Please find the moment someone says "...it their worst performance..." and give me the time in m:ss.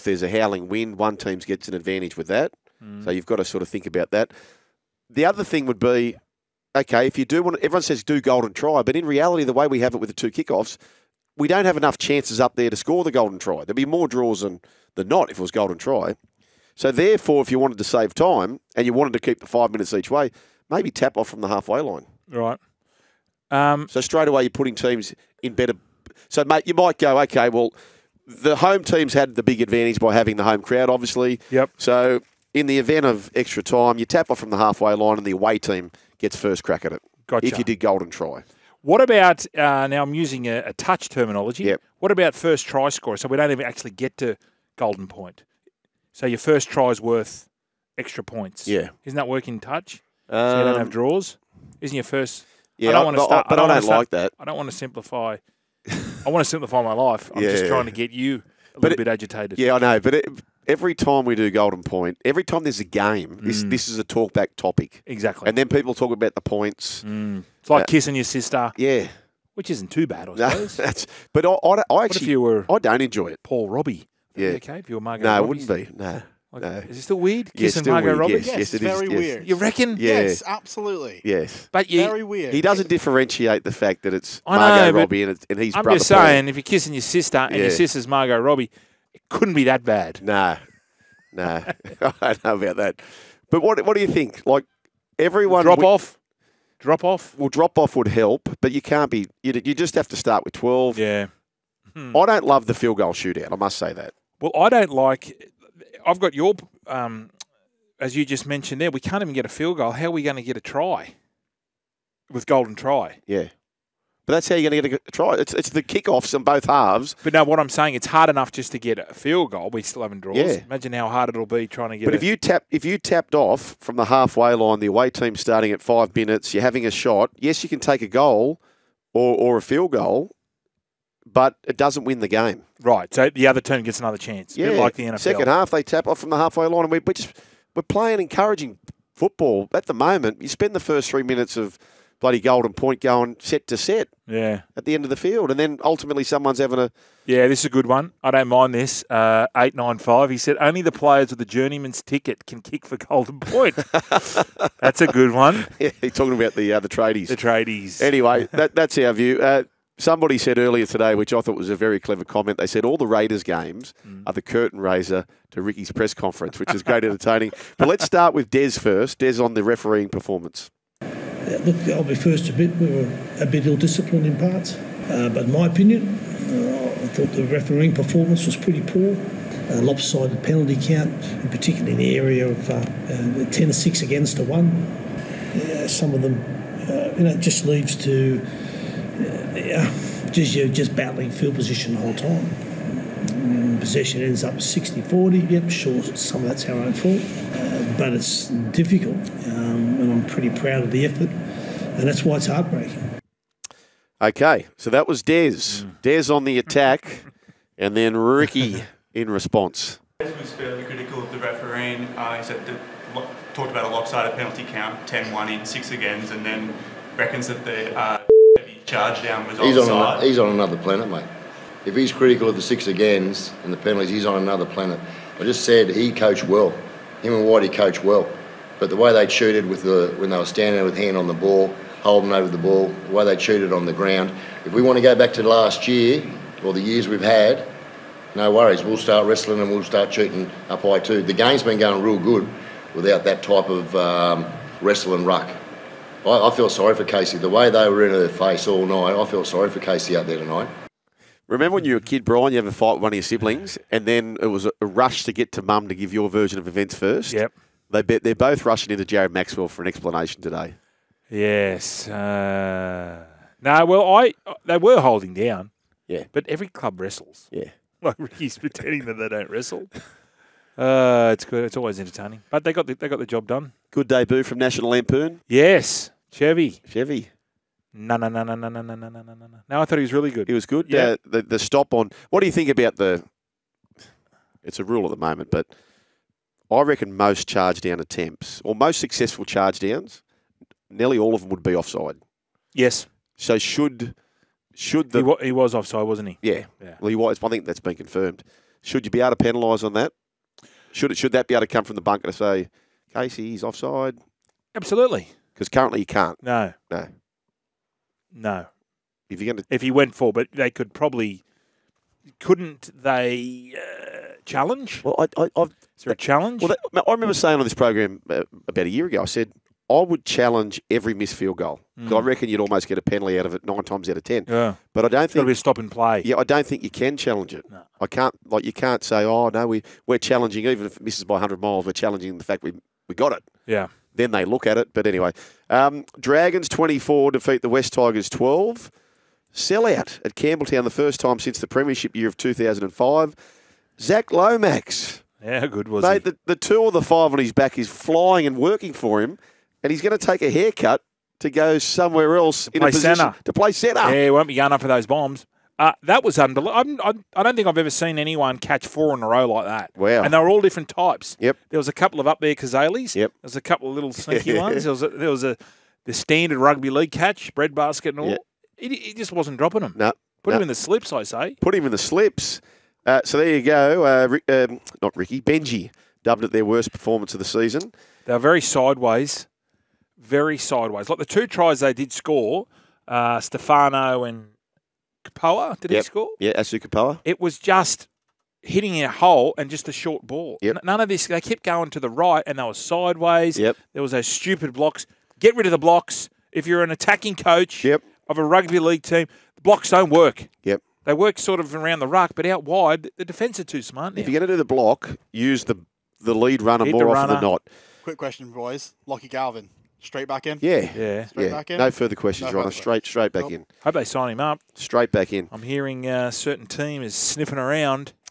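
6:16.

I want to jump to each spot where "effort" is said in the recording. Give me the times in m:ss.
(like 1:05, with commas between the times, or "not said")
3:21.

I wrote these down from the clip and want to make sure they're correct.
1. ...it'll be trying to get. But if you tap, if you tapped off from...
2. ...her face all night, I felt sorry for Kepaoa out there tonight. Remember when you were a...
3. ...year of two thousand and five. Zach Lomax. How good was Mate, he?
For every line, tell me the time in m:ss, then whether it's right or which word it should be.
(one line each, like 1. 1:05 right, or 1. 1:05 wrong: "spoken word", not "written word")
1. 2:01 right
2. 4:08 wrong: "Casey", not "Kepaoa"
3. 5:42 right.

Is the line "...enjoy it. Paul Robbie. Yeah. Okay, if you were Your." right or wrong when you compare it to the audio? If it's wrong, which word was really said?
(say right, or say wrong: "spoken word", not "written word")
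wrong: "Margot", not "Your".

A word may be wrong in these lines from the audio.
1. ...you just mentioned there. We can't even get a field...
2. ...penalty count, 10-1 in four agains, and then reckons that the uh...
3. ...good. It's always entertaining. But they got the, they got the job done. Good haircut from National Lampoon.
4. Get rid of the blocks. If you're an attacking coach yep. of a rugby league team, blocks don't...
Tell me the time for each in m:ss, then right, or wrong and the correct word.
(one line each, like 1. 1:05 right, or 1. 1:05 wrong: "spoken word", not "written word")
1. 1:48 right
2. 3:34 wrong: "six", not "four"
3. 4:31 wrong: "debut", not "haircut"
4. 6:35 right.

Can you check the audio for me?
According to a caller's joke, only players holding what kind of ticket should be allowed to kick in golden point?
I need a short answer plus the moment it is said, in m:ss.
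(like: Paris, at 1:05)
A journeyman's ticket, at 2:31.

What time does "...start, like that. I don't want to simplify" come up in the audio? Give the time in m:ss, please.
0:53.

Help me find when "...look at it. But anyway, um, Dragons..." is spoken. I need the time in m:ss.
5:34.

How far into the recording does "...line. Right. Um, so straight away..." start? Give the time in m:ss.
0:21.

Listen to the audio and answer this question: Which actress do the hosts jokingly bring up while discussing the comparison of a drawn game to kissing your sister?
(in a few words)
Margot Robbie.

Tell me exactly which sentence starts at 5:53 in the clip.
Yeah, he won't be going up for those bombs.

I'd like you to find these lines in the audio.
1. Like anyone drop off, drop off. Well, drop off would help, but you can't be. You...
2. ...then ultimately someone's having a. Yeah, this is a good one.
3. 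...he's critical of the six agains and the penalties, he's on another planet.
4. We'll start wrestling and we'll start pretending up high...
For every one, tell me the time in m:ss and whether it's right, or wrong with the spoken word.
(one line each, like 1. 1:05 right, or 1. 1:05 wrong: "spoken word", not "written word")
1. 1:34 wrong: "everyone", not "anyone"
2. 2:25 right
3. 3:41 right
4. 3:58 wrong: "shooting", not "pretending".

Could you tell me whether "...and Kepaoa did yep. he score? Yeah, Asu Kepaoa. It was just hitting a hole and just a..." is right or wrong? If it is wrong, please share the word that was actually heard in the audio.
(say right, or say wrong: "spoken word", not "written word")
right.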